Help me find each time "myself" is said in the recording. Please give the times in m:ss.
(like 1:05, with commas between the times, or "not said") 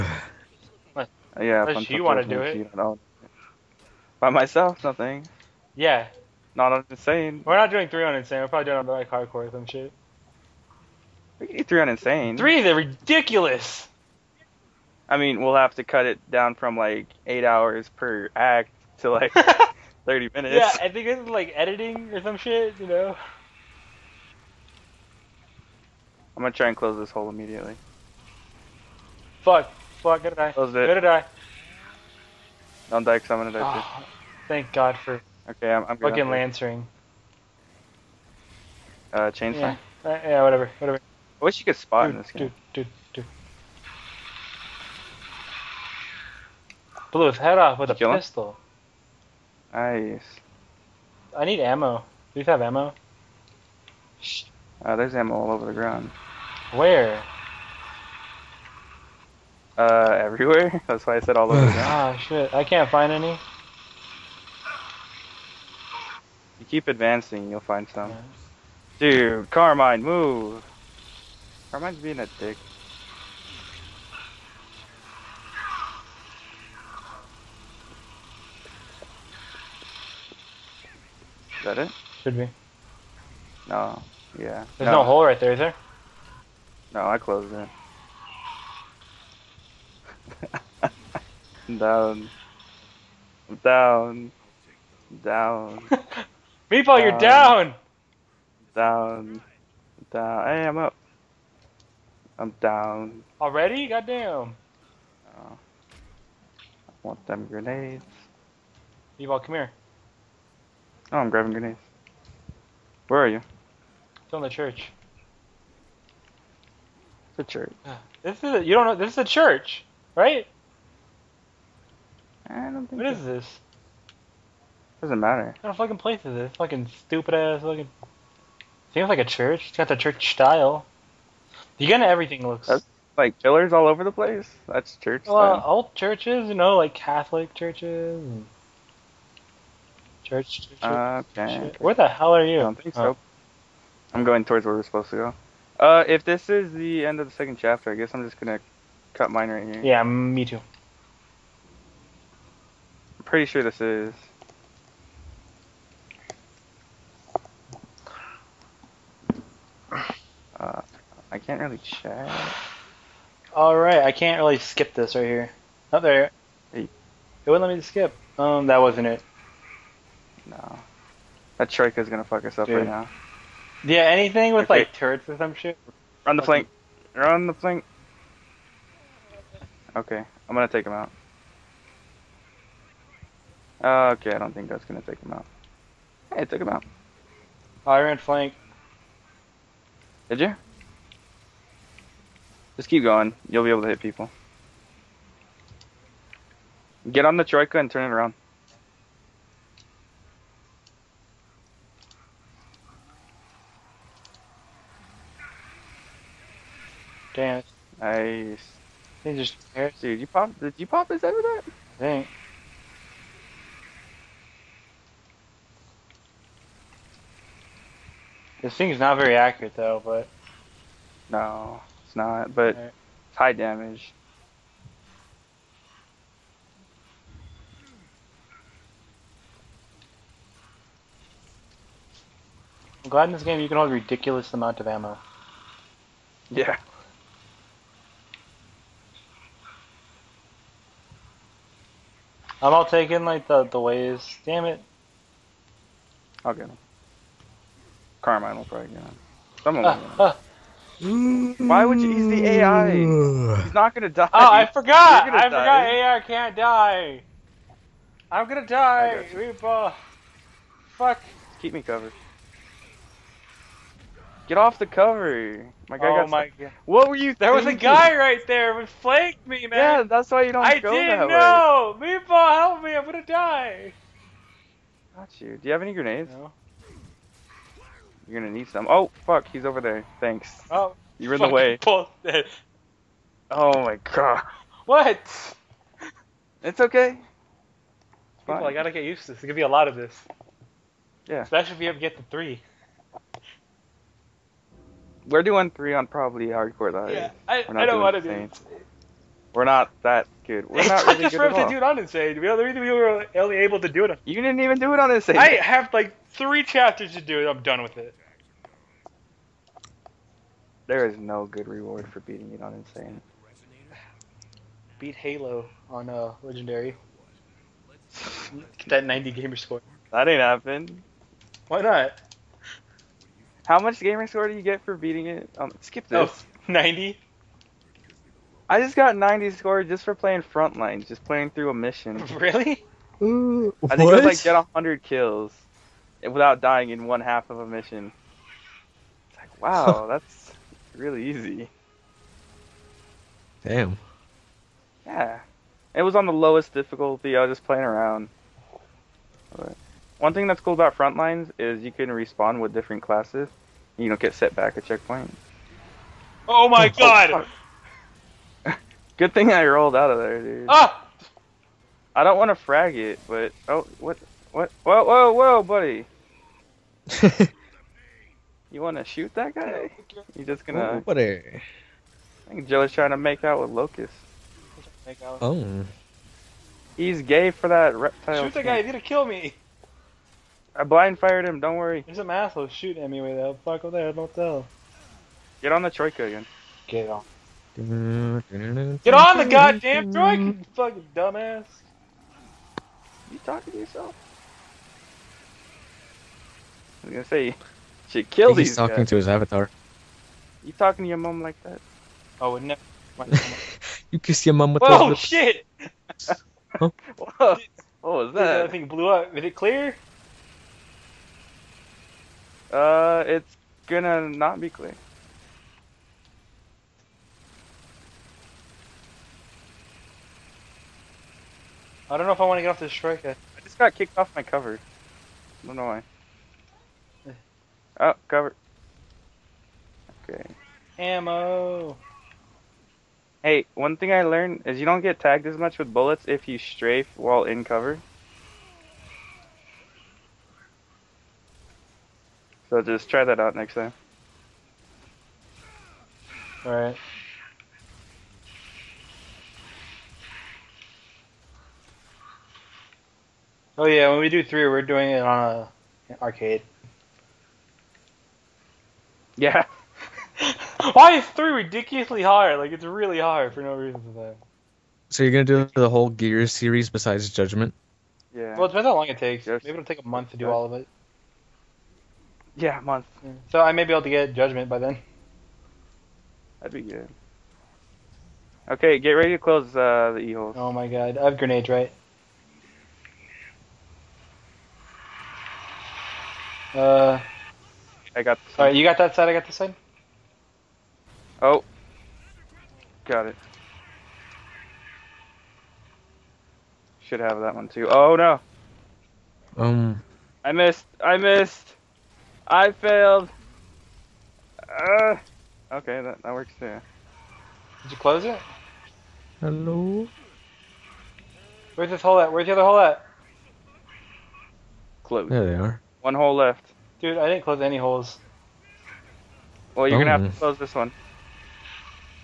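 0:04.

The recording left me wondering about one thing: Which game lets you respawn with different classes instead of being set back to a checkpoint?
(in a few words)
Frontlines.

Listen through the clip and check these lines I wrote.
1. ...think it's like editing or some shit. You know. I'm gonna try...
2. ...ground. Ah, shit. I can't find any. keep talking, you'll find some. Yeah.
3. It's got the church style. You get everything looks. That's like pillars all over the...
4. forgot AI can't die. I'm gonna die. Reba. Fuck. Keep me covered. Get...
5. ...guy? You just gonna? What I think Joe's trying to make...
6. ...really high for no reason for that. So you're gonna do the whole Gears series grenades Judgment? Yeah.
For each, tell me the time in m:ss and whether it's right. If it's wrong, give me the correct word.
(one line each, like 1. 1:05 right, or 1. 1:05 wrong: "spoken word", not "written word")
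1. 0:20 right
2. 1:01 wrong: "advancing", not "talking"
3. 2:09 right
4. 4:15 right
5. 6:09 right
6. 7:42 wrong: "besides", not "grenades".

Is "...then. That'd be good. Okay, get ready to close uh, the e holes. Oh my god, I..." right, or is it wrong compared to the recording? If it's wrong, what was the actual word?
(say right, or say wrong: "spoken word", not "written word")
right.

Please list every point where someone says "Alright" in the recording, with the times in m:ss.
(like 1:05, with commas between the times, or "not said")
2:43, 7:26.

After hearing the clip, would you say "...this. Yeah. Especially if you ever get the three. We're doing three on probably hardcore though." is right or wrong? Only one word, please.
right.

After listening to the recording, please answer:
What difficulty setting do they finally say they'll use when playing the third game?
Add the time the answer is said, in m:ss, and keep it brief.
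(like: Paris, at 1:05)
arcade, at 7:36.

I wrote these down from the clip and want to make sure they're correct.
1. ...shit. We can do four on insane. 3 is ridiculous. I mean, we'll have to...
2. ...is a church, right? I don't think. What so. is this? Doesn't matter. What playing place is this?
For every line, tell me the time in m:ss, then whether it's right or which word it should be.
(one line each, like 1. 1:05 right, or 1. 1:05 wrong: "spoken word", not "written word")
1. 0:09 wrong: "three", not "four"
2. 1:59 wrong: "fucking", not "playing".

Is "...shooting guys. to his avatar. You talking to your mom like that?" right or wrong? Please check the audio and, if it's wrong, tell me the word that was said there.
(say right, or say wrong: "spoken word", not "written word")
wrong: "talking", not "shooting".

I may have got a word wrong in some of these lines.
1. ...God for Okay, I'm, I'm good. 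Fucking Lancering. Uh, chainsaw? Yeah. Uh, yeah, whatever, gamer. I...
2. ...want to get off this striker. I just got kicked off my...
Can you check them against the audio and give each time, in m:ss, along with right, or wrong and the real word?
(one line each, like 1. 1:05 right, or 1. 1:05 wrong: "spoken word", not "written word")
1. 0:34 wrong: "whatever", not "gamer"
2. 7:02 right.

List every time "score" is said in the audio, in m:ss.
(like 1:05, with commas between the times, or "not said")
5:19, 5:24, 5:29.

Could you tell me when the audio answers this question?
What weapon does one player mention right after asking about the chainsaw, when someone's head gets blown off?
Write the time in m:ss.
0:48.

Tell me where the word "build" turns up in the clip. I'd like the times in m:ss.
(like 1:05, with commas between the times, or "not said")
not said.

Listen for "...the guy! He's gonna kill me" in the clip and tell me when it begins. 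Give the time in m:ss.
6:18.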